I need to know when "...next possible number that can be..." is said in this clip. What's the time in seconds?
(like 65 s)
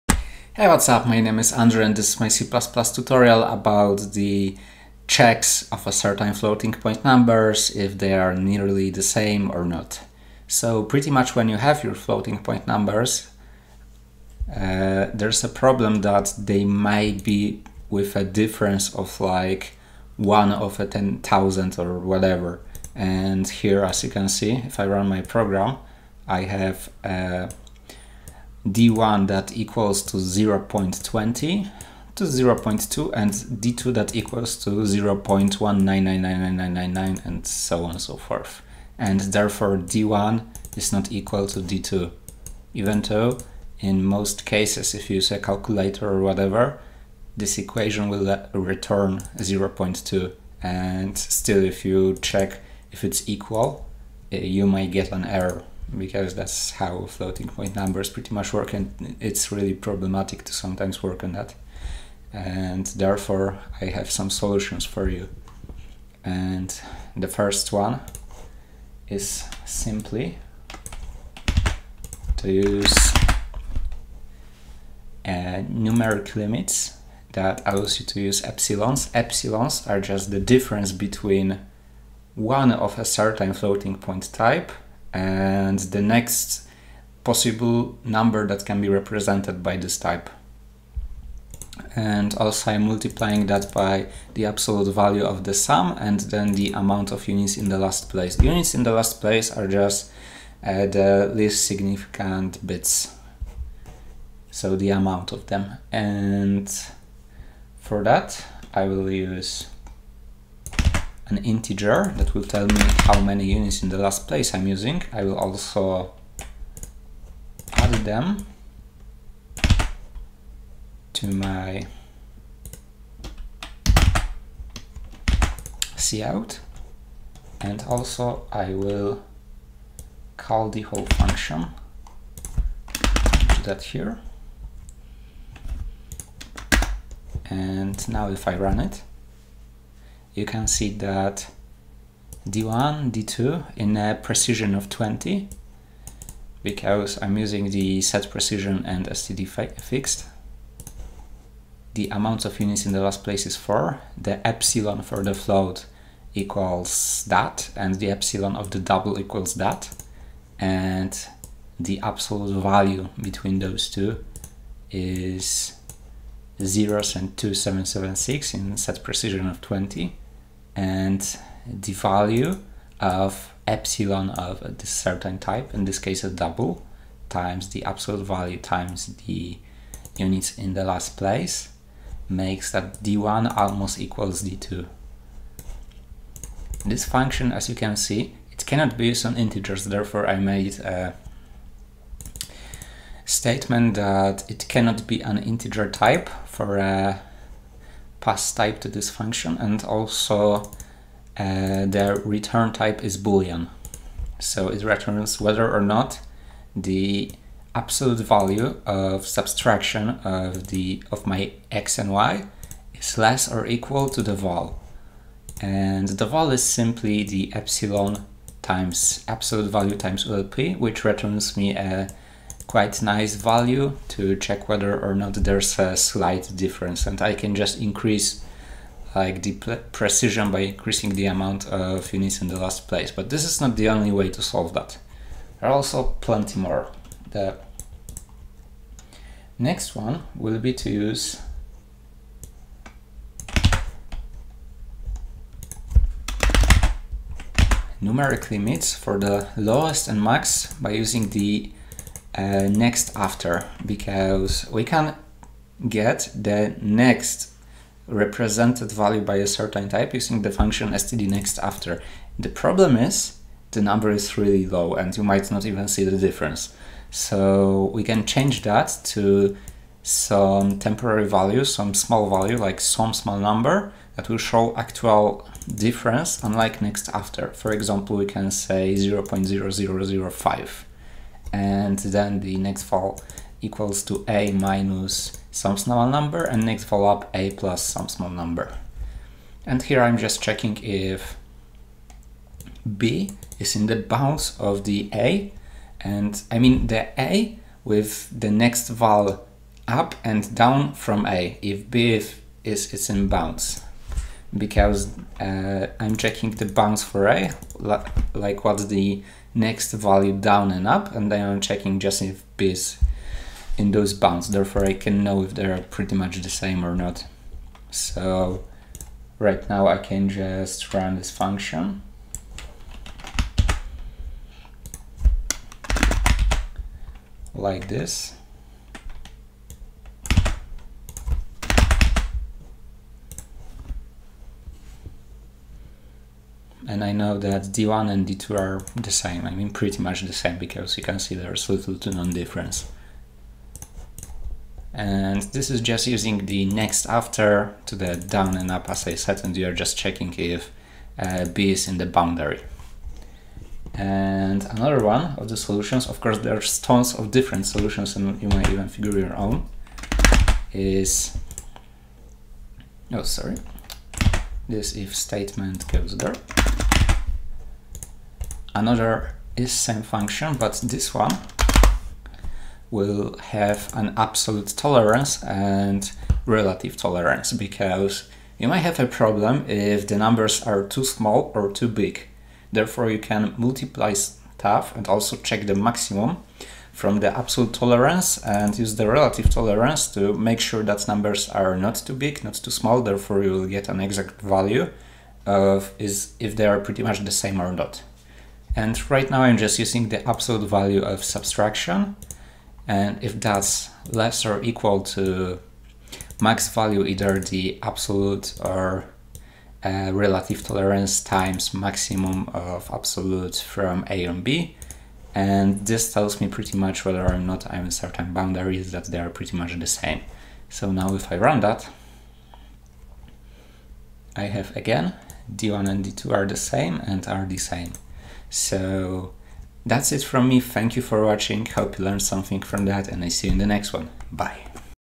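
86 s.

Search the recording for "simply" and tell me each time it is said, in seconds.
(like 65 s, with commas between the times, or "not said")
69 s, 216 s.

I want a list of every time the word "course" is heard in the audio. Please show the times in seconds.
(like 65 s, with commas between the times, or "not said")
356 s.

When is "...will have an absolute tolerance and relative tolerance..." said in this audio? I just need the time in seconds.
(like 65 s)
372 s.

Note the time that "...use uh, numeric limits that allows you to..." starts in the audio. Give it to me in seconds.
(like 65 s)
72 s.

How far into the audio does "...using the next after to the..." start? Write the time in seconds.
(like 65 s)
346 s.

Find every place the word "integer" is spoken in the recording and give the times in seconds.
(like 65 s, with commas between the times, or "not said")
111 s, 189 s, 195 s.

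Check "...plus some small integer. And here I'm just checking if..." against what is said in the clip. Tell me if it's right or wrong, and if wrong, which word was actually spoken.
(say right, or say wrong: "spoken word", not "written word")
wrong: "number", not "integer".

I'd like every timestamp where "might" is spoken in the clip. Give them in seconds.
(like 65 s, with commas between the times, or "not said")
16 s, 54 s, 265 s, 358 s, 378 s.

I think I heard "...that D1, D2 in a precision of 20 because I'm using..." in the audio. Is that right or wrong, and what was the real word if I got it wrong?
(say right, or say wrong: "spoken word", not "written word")
right.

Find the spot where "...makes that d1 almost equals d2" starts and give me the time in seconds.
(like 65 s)
182 s.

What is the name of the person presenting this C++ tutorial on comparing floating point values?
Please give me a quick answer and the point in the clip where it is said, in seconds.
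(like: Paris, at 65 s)
Andrew, at 1 s.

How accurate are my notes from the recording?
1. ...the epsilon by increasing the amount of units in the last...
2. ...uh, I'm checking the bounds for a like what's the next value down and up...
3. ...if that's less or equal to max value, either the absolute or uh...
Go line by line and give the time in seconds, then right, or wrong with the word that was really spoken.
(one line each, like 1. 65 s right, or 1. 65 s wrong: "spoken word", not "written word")
1. 229 s wrong: "precision", not "epsilon"
2. 305 s right
3. 403 s right.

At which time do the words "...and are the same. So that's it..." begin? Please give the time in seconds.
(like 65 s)
427 s.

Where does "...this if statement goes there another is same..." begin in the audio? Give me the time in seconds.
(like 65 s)
364 s.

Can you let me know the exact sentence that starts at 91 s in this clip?
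And also I'm multiplying that by the absolute value of the sum and then the amount of units in the last place.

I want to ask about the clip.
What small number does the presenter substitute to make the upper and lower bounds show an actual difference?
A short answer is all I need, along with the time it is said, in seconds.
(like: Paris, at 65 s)
0.0005, at 278 s.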